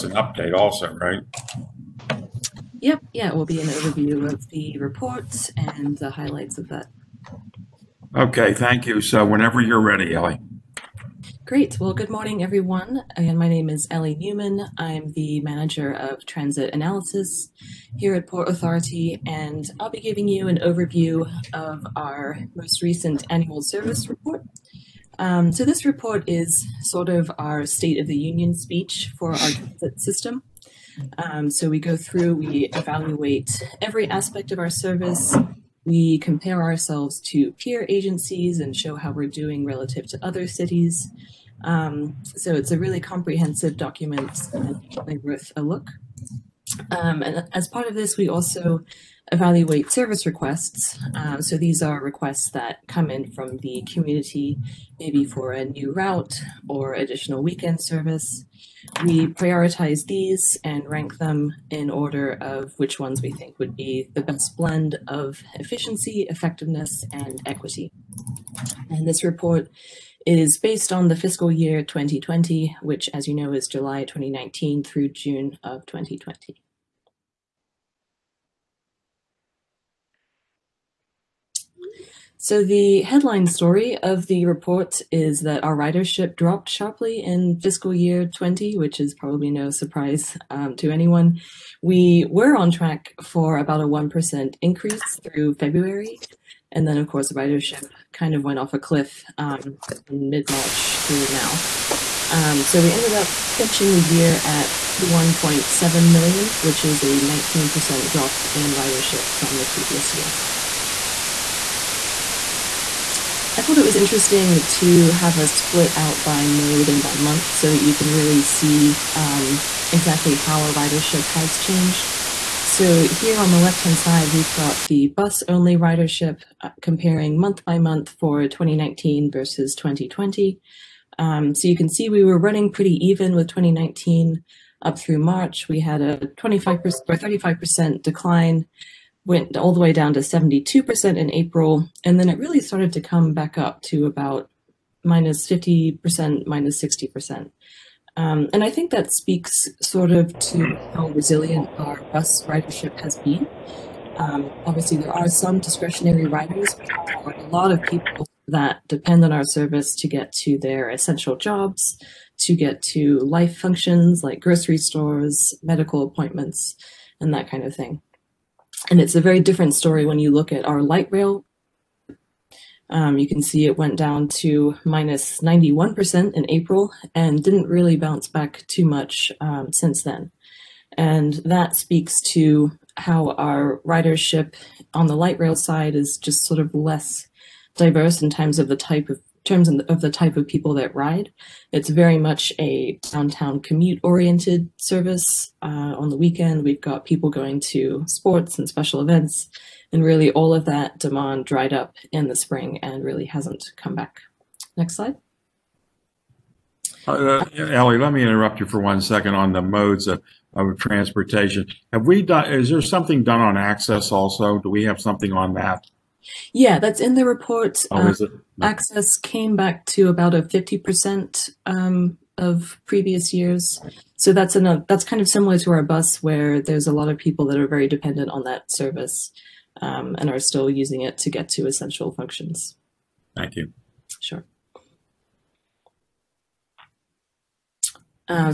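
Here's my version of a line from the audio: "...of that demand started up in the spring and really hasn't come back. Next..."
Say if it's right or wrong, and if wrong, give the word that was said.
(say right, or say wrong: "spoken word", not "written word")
wrong: "dried", not "started".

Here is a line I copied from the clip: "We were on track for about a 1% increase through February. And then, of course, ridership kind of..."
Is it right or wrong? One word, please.
right.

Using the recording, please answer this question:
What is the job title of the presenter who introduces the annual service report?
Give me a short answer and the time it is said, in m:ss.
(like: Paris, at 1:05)
Manager of transit analysis, at 0:15.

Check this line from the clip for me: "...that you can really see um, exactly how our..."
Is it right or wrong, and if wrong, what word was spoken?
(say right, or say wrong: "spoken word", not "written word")
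right.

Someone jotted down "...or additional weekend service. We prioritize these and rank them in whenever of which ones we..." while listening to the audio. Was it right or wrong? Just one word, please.
wrong.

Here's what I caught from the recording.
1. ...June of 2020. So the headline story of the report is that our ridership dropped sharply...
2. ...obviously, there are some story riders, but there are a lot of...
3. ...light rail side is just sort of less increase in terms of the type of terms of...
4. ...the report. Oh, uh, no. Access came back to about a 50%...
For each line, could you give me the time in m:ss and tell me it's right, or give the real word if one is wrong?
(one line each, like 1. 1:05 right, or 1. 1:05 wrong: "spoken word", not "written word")
1. 1:15 right
2. 2:34 wrong: "discretionary", not "story"
3. 3:05 wrong: "diverse", not "increase"
4. 3:37 right.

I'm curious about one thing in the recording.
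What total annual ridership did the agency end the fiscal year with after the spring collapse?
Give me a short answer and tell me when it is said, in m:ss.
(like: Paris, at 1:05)
51.7 million, at 1:44.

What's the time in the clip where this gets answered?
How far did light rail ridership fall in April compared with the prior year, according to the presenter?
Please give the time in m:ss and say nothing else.
2:54.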